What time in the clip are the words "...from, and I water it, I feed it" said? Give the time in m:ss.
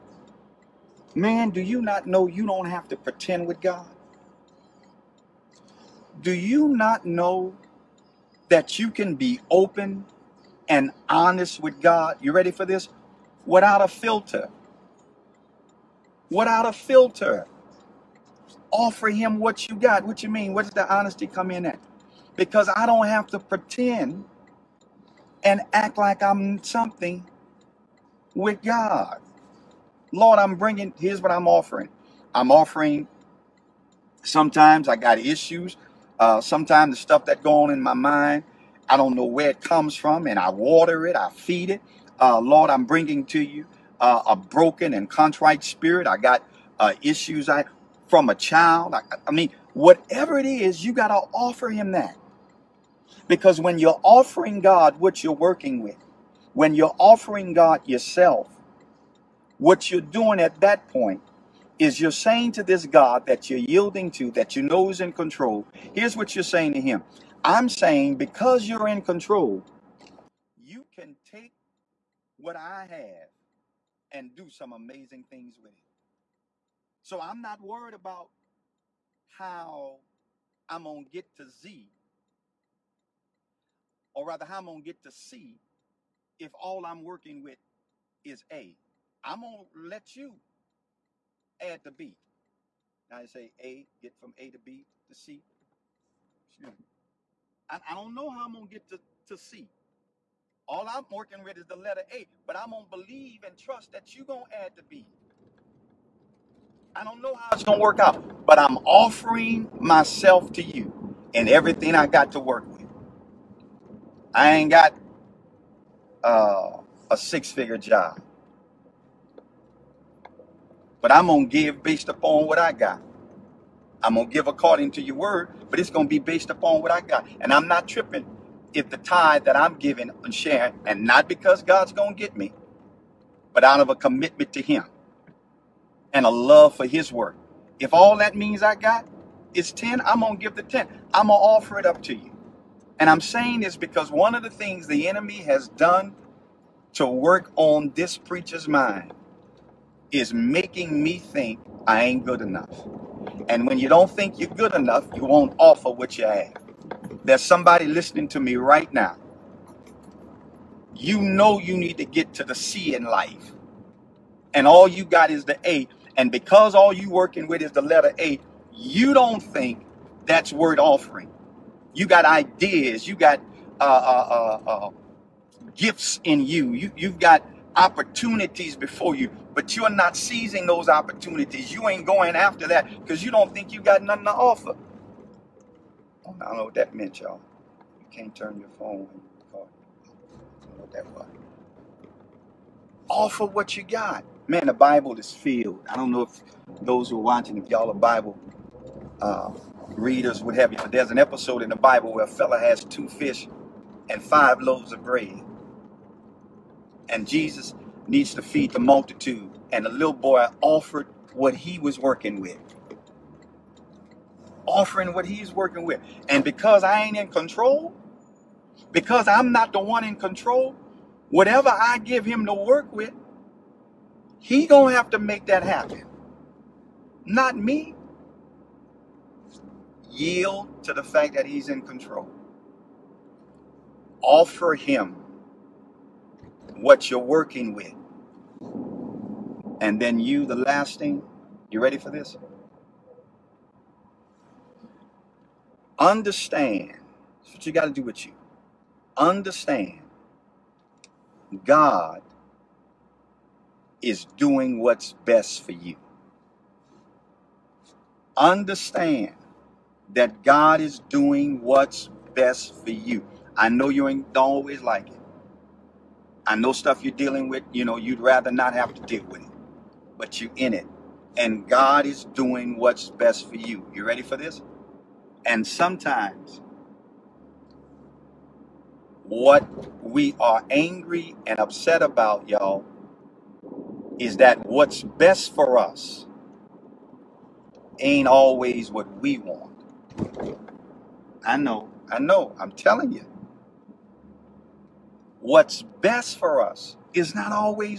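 0:39.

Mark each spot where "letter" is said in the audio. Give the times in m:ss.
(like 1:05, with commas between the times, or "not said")
1:41, 2:47.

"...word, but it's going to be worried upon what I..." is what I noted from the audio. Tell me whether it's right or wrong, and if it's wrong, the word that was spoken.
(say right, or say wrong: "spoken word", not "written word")
wrong: "based", not "worried".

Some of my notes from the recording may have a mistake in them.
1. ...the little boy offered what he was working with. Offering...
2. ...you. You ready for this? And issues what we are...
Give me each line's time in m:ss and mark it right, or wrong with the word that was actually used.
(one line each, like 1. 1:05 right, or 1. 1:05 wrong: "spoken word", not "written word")
1. 3:29 right
2. 4:33 wrong: "sometimes", not "issues".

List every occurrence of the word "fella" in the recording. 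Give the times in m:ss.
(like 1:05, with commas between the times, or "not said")
3:22.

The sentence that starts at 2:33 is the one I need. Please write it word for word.
And when you don't think you're good enough, you won't offer what you have.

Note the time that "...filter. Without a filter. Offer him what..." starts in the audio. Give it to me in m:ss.
0:13.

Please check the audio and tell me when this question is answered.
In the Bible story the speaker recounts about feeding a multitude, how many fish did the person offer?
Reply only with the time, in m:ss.
3:22.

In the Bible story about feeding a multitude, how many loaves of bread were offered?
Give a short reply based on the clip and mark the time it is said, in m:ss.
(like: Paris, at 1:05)
5, at 3:24.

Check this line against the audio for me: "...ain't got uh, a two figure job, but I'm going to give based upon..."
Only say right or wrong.
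wrong.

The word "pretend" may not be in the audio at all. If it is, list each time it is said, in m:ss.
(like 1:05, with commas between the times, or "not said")
0:02, 0:23.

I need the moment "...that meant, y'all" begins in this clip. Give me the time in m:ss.
3:06.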